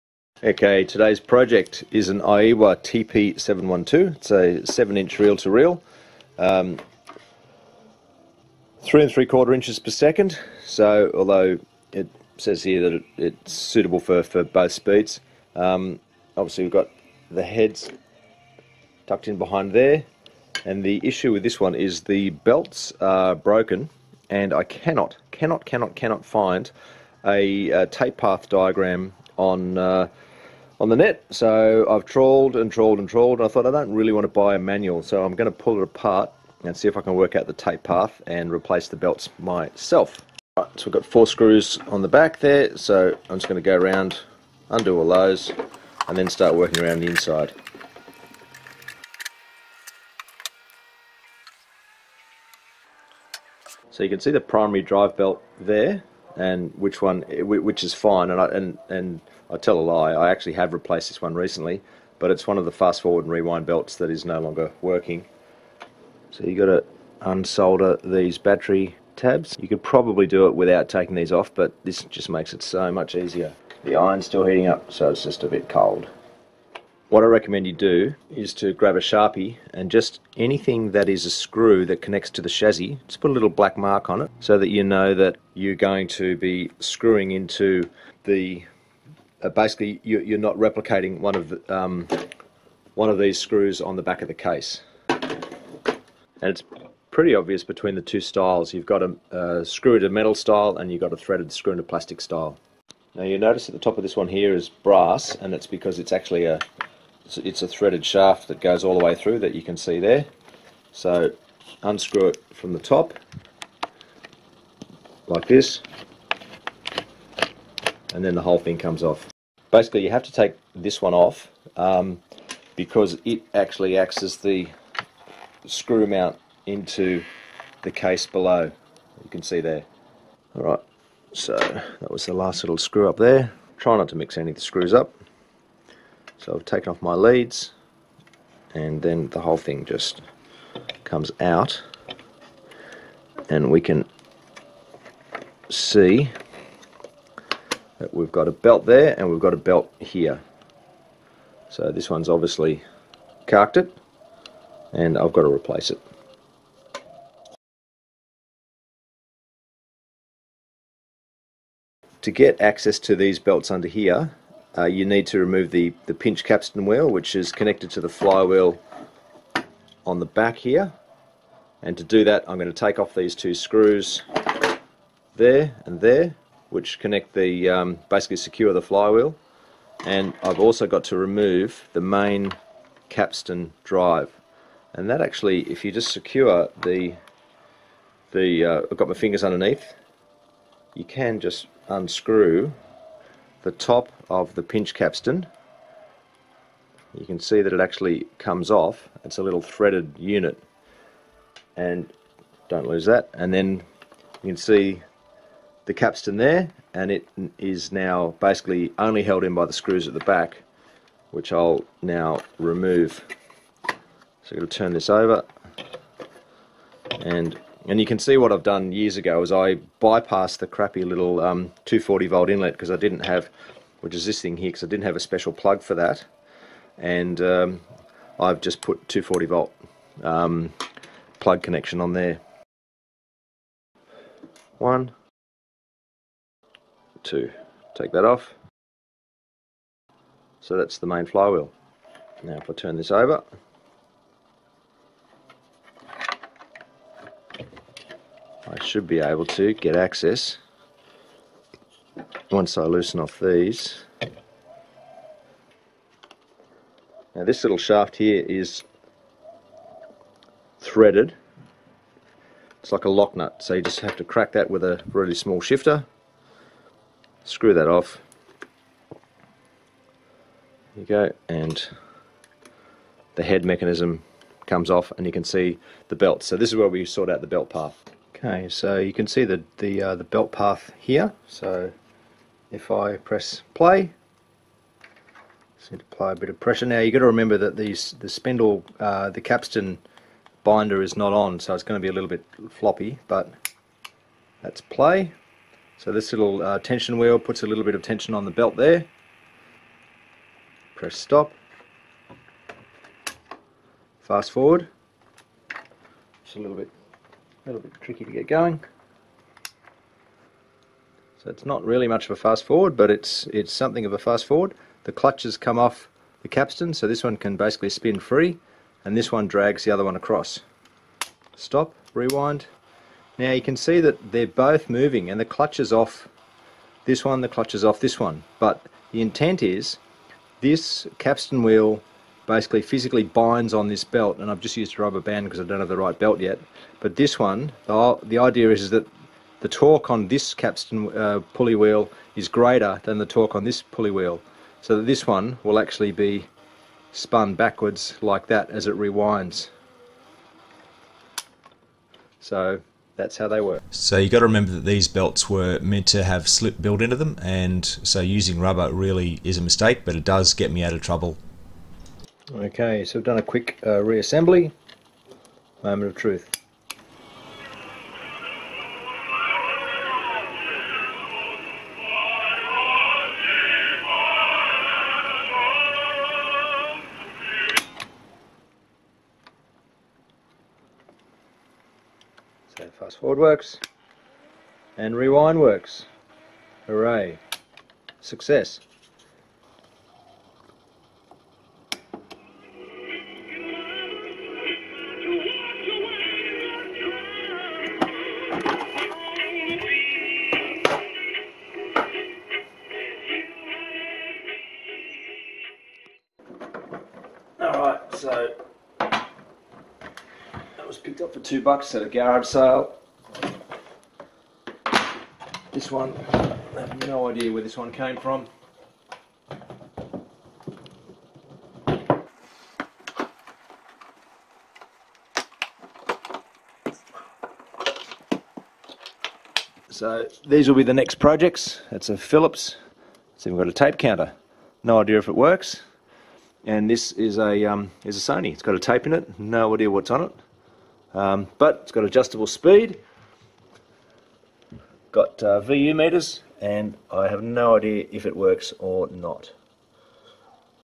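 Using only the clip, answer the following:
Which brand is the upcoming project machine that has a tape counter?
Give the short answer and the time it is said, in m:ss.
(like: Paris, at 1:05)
Philips, at 7:12.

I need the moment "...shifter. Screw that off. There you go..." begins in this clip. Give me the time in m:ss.
4:25.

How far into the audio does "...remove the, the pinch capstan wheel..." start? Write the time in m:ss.
2:45.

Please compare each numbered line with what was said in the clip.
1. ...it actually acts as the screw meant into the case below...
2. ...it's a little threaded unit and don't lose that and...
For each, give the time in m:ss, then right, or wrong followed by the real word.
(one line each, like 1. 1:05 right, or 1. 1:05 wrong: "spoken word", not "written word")
1. 2:03 wrong: "mount", not "meant"
2. 3:19 right.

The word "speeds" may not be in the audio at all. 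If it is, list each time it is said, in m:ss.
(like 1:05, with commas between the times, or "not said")
0:14, 7:22.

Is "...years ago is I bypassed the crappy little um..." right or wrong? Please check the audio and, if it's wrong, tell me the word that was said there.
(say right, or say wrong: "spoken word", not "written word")
right.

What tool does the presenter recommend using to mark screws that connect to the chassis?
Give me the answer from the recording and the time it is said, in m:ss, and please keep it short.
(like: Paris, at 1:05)
Sharpie, at 1:19.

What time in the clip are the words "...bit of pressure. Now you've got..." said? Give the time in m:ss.
4:46.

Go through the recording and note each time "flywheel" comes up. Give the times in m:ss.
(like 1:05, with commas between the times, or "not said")
2:48, 2:58, 4:01.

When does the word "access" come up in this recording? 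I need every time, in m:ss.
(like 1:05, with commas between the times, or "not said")
2:42, 4:09.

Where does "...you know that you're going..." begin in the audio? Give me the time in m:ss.
1:24.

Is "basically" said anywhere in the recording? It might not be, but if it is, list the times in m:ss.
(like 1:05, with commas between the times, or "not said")
1:29, 1:59, 2:58, 3:28, 5:17, 5:32.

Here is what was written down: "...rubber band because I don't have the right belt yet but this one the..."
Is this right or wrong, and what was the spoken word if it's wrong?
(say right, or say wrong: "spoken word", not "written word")
right.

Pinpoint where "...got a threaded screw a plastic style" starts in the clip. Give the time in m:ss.
1:41.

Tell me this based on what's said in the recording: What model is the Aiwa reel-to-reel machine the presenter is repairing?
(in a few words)
TP712.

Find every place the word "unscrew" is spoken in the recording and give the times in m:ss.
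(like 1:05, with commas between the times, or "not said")
1:51, 3:11.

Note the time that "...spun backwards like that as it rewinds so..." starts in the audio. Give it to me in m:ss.
5:47.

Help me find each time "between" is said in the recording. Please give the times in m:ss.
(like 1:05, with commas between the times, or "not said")
1:37.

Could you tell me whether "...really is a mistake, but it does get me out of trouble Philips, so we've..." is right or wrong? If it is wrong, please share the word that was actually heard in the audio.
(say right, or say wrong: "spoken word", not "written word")
wrong: "Okay", not "Philips".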